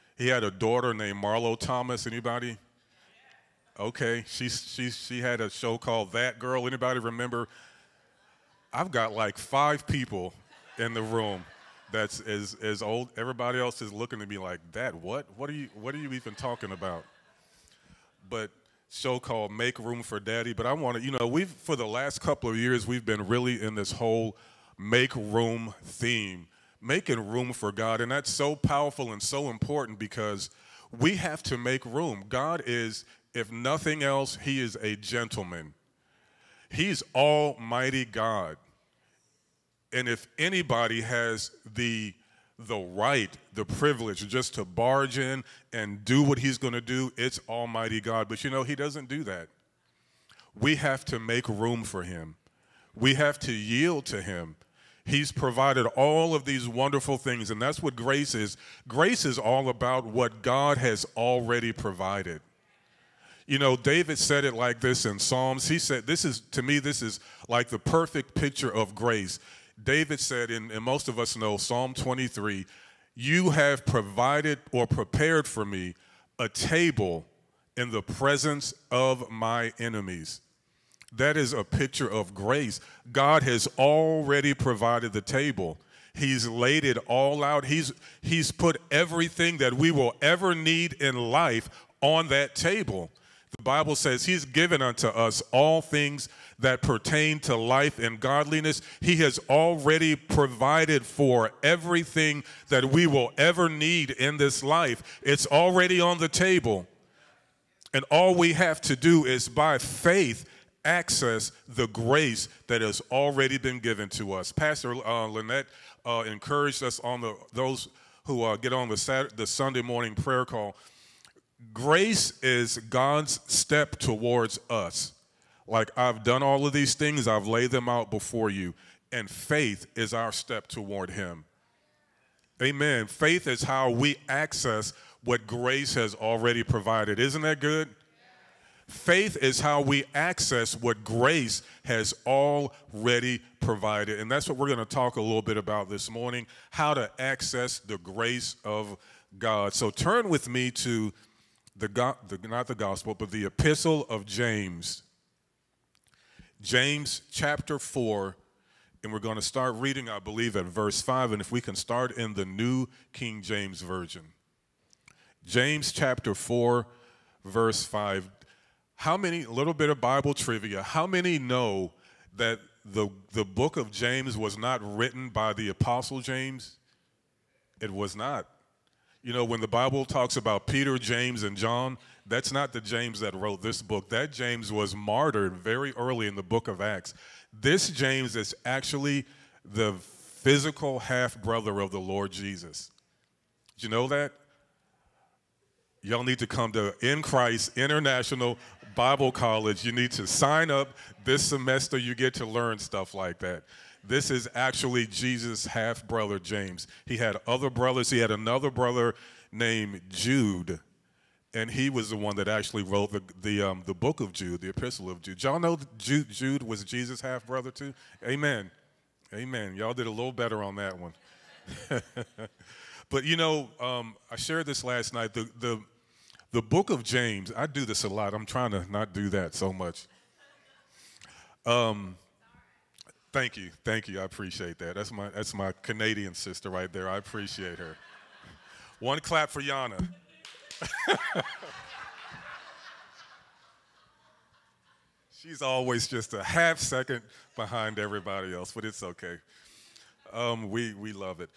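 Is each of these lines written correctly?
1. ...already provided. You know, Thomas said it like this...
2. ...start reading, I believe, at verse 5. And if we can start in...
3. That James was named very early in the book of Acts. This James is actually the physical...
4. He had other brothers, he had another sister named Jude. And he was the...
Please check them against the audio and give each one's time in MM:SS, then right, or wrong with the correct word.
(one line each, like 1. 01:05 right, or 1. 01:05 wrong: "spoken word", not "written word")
1. 01:01 wrong: "David", not "Thomas"
2. 02:39 right
3. 03:04 wrong: "martyred", not "named"
4. 03:27 wrong: "brother", not "sister".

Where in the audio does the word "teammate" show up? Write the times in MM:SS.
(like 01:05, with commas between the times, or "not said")
not said.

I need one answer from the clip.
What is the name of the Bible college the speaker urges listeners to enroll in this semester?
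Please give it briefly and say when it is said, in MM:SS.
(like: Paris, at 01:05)
In Christ International Bible College, at 03:17.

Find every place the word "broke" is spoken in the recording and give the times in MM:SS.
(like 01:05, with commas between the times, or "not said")
not said.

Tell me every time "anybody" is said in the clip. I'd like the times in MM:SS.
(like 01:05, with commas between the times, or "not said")
00:02, 00:06, 00:40.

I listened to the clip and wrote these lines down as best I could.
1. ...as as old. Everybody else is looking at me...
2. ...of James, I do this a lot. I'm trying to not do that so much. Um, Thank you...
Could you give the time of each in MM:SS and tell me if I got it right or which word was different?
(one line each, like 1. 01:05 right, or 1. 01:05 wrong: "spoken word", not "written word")
1. 00:12 right
2. 03:46 right.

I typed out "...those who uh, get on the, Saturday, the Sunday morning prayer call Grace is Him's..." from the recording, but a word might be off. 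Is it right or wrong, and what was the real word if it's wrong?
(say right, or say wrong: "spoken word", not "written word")
wrong: "God", not "Him".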